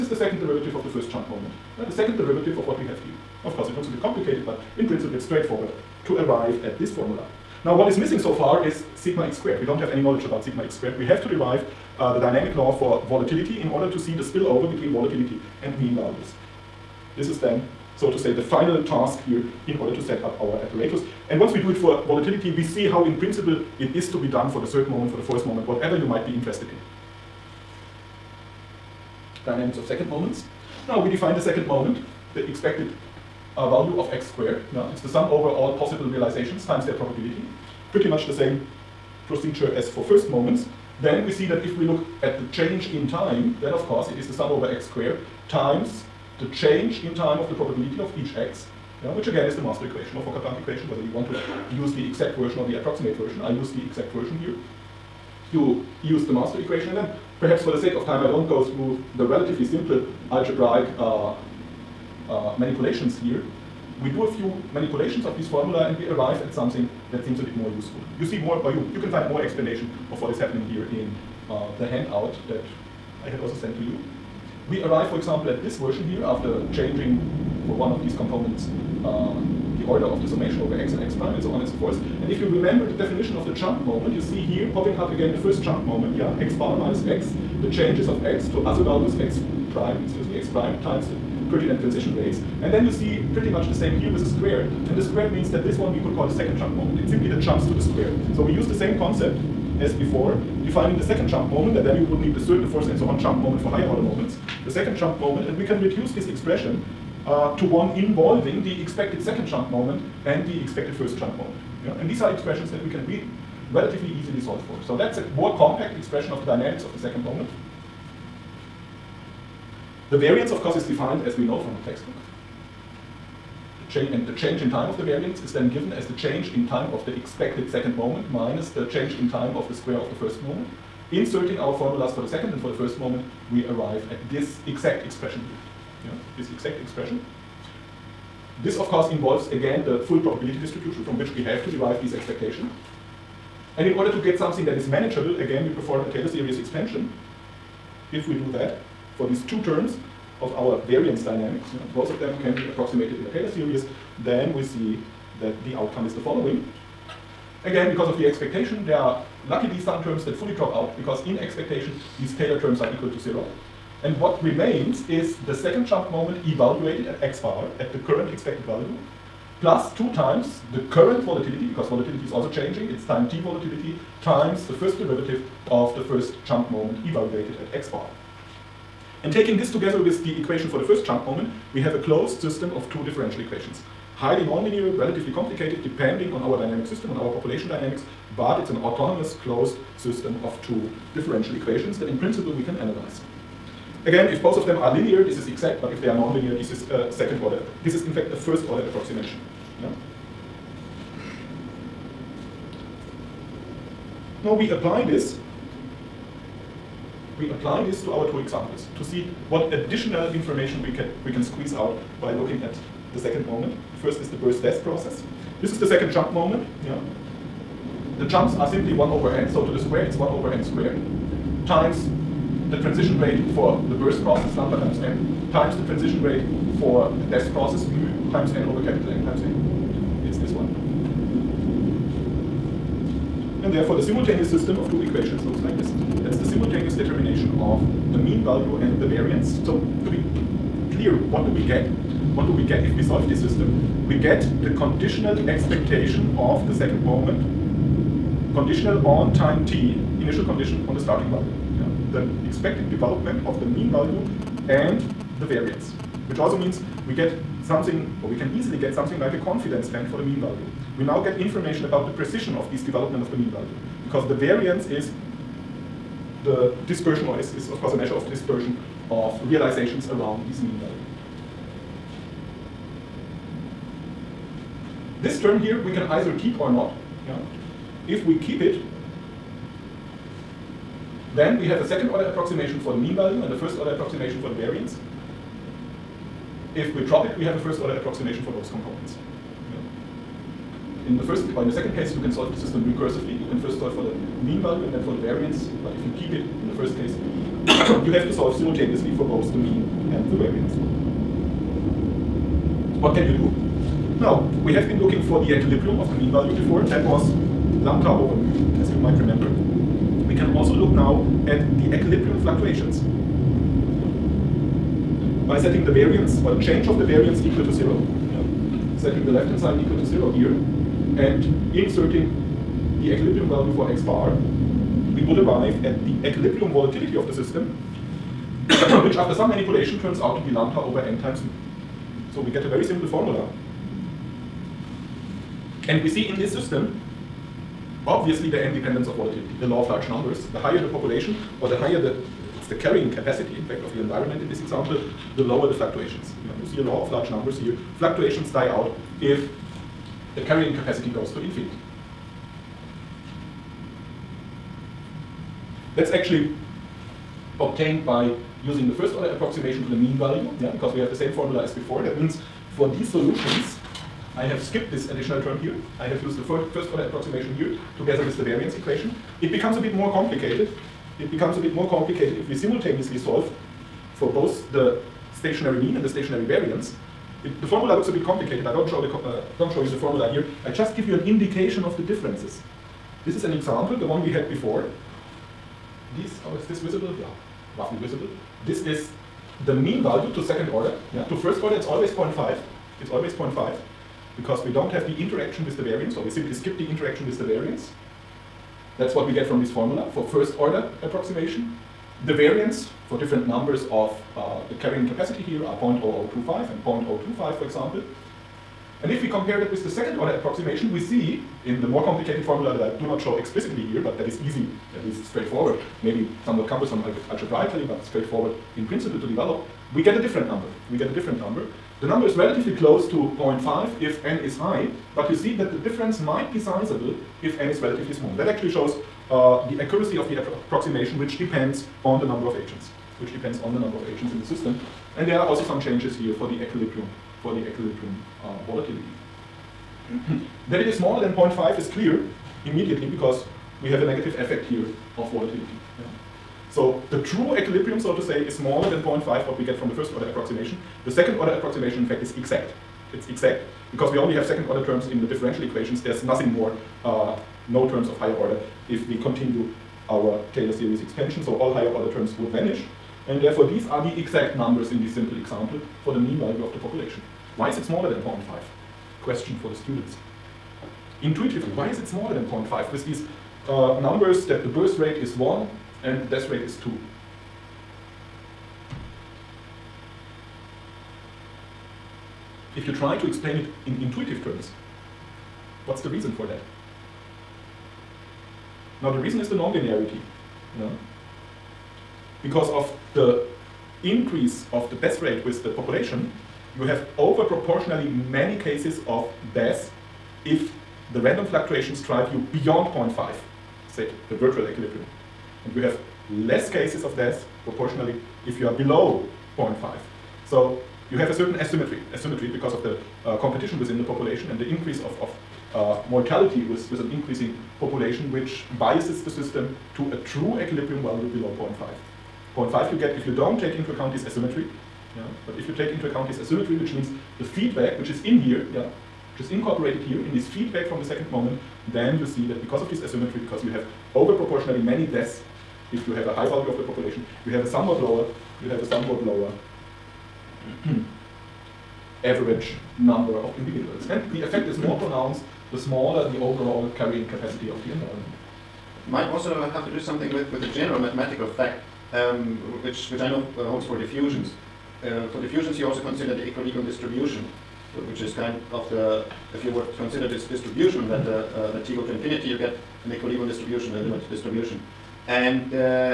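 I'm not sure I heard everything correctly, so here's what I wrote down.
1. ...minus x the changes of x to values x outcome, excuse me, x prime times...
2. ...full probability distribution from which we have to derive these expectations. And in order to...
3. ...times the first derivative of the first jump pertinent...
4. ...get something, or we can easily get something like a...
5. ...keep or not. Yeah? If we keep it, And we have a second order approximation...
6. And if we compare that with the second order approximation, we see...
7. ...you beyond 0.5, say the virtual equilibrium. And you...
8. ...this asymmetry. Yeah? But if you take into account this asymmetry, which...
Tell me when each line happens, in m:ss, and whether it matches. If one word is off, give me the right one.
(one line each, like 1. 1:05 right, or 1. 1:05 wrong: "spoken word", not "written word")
1. 1:26 wrong: "prime", not "outcome"
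2. 2:20 right
3. 2:54 wrong: "moment", not "pertinent"
4. 4:17 right
5. 4:36 wrong: "Then", not "And"
6. 6:49 right
7. 8:22 right
8. 8:44 right.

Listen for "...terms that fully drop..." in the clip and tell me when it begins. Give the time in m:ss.
2:40.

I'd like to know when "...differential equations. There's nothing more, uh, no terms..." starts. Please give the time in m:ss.
7:35.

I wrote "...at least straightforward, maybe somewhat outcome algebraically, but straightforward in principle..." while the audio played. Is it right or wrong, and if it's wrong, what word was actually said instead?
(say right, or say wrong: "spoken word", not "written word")
wrong: "cumbersome", not "outcome".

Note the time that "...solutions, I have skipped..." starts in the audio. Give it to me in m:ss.
6:03.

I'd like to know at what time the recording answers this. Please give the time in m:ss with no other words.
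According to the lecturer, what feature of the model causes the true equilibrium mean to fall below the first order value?
8:09.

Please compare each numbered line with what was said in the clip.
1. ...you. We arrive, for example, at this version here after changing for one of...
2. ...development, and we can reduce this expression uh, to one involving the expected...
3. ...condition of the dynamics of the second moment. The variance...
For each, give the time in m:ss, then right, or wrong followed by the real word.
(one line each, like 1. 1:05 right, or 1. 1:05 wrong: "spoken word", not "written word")
1. 1:13 right
2. 1:45 wrong: "moment", not "development"
3. 1:55 wrong: "expression", not "condition".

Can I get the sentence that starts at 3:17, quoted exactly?
This is in fact a first order approximation.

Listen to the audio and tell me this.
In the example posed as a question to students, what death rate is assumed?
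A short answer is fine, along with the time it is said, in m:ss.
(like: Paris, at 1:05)
2, at 7:56.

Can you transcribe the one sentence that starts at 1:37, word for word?
It's simply the jumps to the square.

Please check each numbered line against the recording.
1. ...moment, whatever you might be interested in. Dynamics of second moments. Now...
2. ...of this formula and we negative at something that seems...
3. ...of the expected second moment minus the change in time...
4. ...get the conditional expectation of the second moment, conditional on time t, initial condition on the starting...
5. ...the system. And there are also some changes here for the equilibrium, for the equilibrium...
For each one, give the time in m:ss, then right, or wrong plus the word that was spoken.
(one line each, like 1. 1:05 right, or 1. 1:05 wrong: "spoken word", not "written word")
1. 0:25 right
2. 1:05 wrong: "arrive", not "negative"
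3. 2:06 right
4. 4:04 right
5. 7:14 right.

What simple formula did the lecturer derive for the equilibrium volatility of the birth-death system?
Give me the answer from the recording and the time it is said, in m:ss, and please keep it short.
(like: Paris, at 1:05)
lambda over n times mu, at 5:30.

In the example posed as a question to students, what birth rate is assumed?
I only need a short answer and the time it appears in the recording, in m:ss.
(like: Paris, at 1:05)
1, at 7:54.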